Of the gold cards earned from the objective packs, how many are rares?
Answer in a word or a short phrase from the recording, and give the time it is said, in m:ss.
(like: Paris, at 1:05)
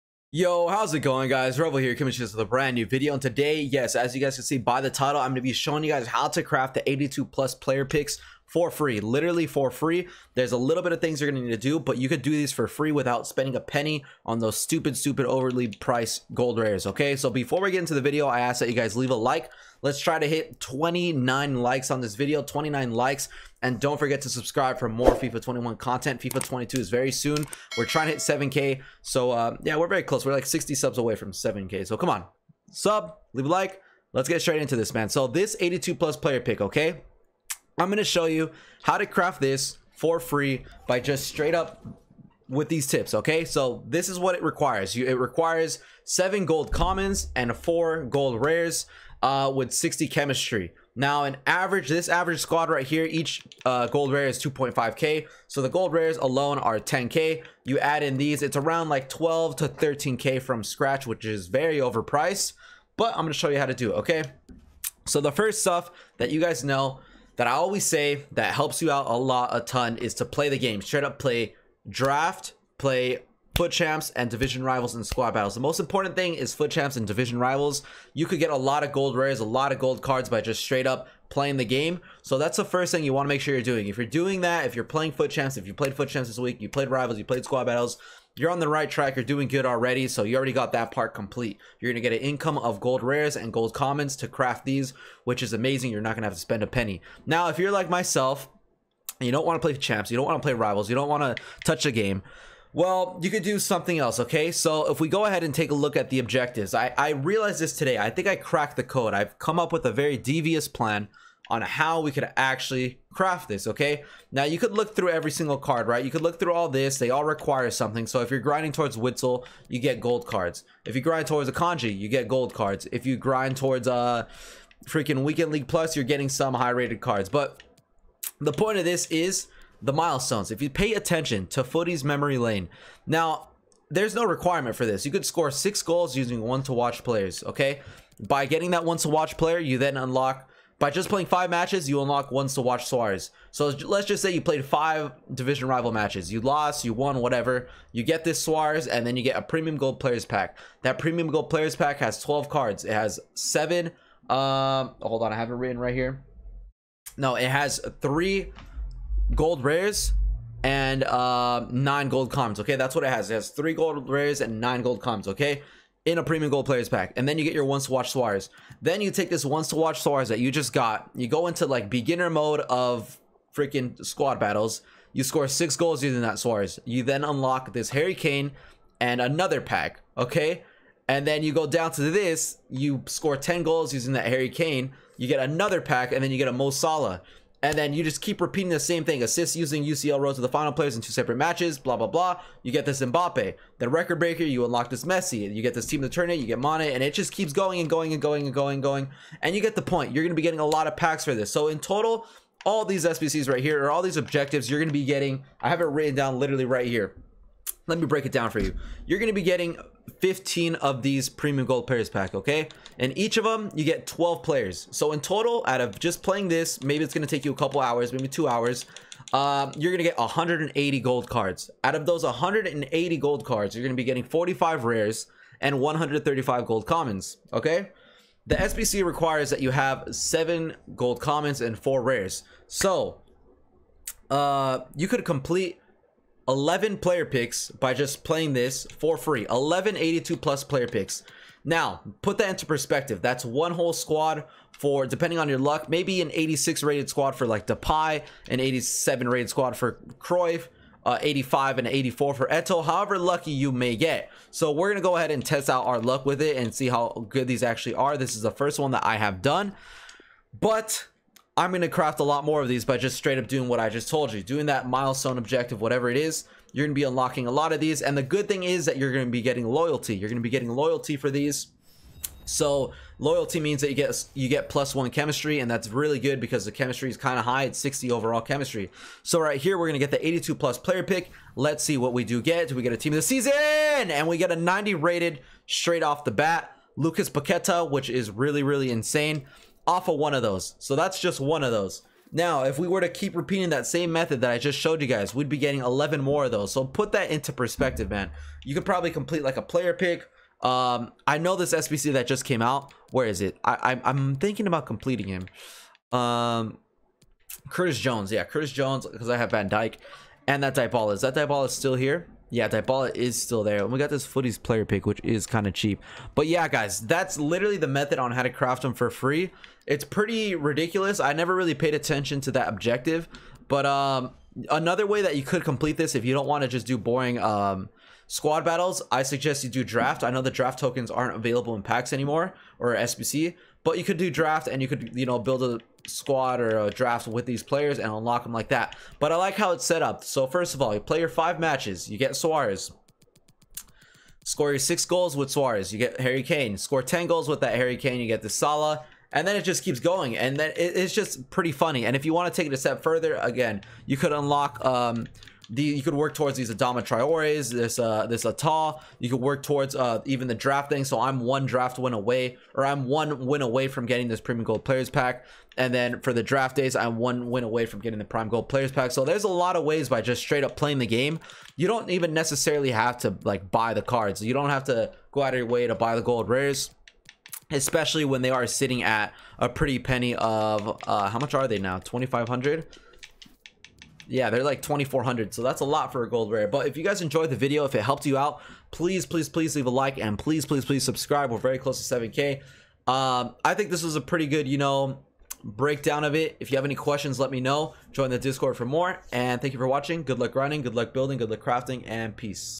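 45, at 3:44.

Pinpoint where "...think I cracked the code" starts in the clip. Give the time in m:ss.
1:48.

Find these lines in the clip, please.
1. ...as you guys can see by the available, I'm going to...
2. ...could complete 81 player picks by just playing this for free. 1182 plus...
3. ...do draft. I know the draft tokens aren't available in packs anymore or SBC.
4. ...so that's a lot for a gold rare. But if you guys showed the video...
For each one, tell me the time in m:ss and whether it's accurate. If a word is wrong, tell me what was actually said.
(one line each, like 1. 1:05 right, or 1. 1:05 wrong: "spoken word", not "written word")
1. 0:03 wrong: "title", not "available"
2. 3:55 wrong: "11", not "81"
3. 5:29 right
4. 6:25 wrong: "enjoyed", not "showed".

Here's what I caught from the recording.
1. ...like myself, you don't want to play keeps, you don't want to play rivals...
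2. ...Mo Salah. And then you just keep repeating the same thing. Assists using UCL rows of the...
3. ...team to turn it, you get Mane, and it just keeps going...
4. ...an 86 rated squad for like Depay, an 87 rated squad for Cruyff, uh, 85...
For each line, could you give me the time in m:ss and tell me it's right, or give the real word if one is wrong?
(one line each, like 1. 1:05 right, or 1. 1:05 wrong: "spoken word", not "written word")
1. 1:37 wrong: "champs", not "keeps"
2. 3:06 right
3. 3:15 right
4. 4:06 right.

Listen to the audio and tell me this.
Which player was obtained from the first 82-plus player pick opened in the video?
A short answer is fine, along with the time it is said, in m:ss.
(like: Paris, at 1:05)
Lucas Paqueta, at 4:46.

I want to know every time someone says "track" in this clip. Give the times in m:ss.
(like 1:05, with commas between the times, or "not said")
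1:28.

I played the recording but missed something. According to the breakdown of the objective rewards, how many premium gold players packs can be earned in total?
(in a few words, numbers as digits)
15.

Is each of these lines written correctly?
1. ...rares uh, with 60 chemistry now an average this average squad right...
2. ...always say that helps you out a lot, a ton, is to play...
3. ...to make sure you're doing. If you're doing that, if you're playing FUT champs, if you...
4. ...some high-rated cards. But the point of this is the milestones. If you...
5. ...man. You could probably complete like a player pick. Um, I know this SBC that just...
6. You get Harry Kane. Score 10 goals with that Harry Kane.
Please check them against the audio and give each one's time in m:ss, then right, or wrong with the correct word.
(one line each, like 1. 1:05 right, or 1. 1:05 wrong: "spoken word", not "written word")
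1. 0:48 right
2. 1:07 right
3. 1:23 right
4. 2:06 right
5. 4:58 right
6. 5:45 right.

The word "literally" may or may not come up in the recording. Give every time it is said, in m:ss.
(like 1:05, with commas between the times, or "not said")
0:08, 3:26, 5:17.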